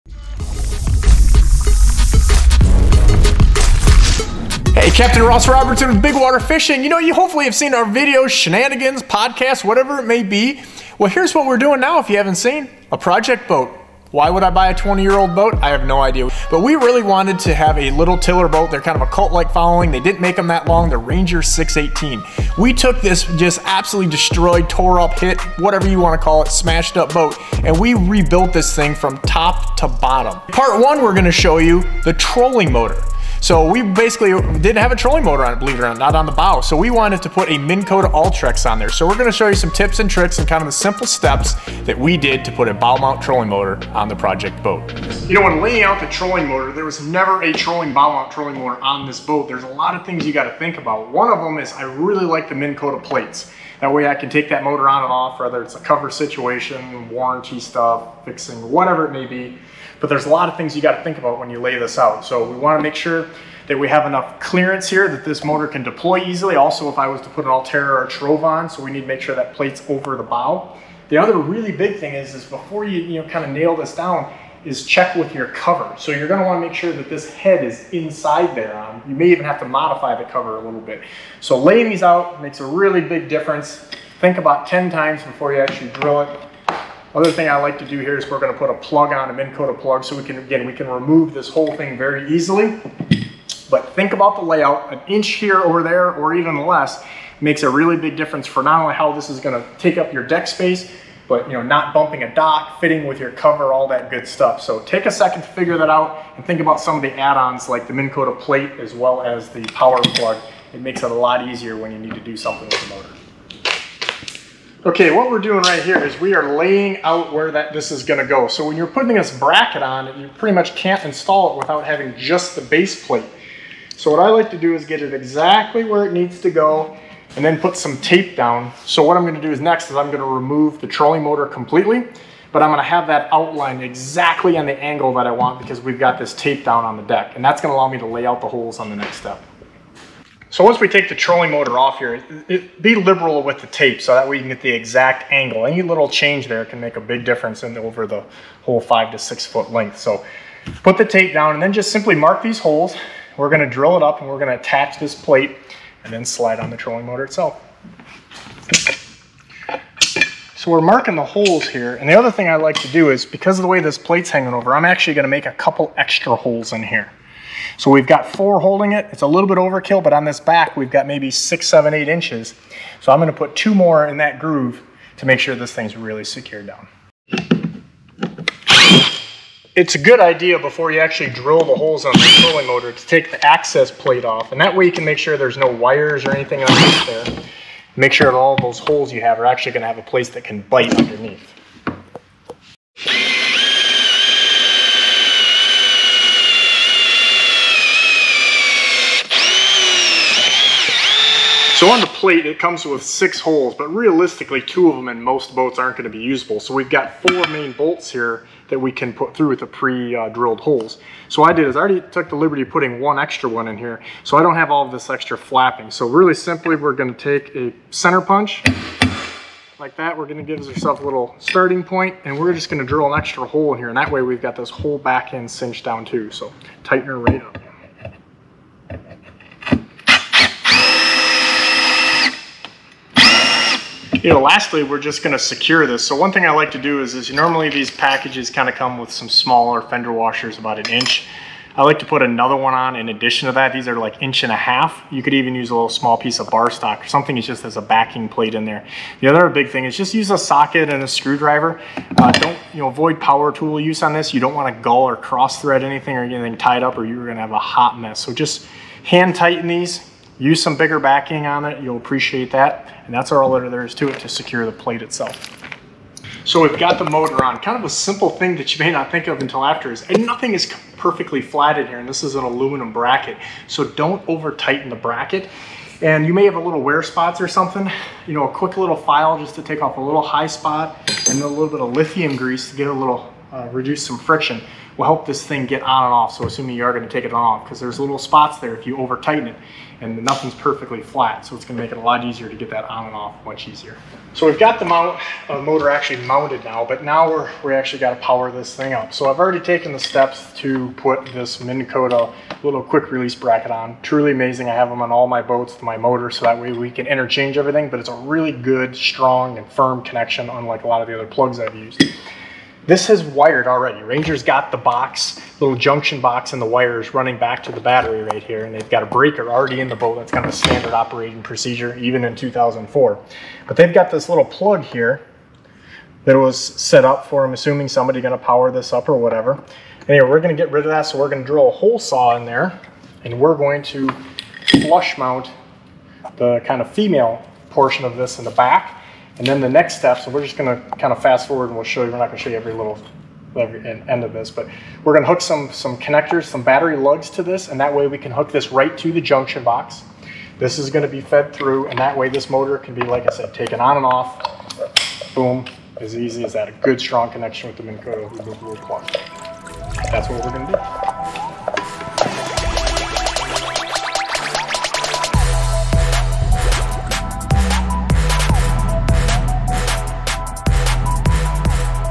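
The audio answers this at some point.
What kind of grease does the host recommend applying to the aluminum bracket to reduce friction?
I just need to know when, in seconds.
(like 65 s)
281 s.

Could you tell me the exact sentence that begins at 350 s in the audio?
This is going to be fed through, and that way this motor can be, like I said, taken on and off.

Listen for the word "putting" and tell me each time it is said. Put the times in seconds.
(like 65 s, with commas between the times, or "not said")
118 s, 212 s.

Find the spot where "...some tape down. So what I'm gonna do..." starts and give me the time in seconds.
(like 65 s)
127 s.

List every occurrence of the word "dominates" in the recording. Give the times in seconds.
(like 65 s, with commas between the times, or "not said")
not said.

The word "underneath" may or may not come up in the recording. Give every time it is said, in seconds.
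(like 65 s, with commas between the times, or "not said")
186 s, 190 s.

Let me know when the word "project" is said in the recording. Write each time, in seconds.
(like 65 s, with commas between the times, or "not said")
12 s, 44 s.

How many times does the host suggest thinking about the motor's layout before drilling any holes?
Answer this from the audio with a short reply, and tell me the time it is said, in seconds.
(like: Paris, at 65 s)
10, at 84 s.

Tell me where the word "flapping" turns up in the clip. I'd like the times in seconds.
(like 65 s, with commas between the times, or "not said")
215 s.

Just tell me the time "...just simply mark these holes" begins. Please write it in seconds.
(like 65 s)
151 s.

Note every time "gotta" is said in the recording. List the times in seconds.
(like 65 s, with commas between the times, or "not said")
50 s, 60 s, 297 s.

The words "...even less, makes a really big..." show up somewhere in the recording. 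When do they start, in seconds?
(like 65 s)
96 s.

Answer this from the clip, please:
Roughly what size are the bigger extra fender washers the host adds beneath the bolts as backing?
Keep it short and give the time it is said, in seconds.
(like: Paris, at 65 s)
inch and a half, at 244 s.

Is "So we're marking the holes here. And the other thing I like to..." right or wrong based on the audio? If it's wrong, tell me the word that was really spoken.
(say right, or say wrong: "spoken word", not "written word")
right.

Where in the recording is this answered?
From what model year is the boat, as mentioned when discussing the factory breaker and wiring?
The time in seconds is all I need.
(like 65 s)
322 s.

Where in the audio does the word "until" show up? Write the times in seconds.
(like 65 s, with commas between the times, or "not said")
269 s.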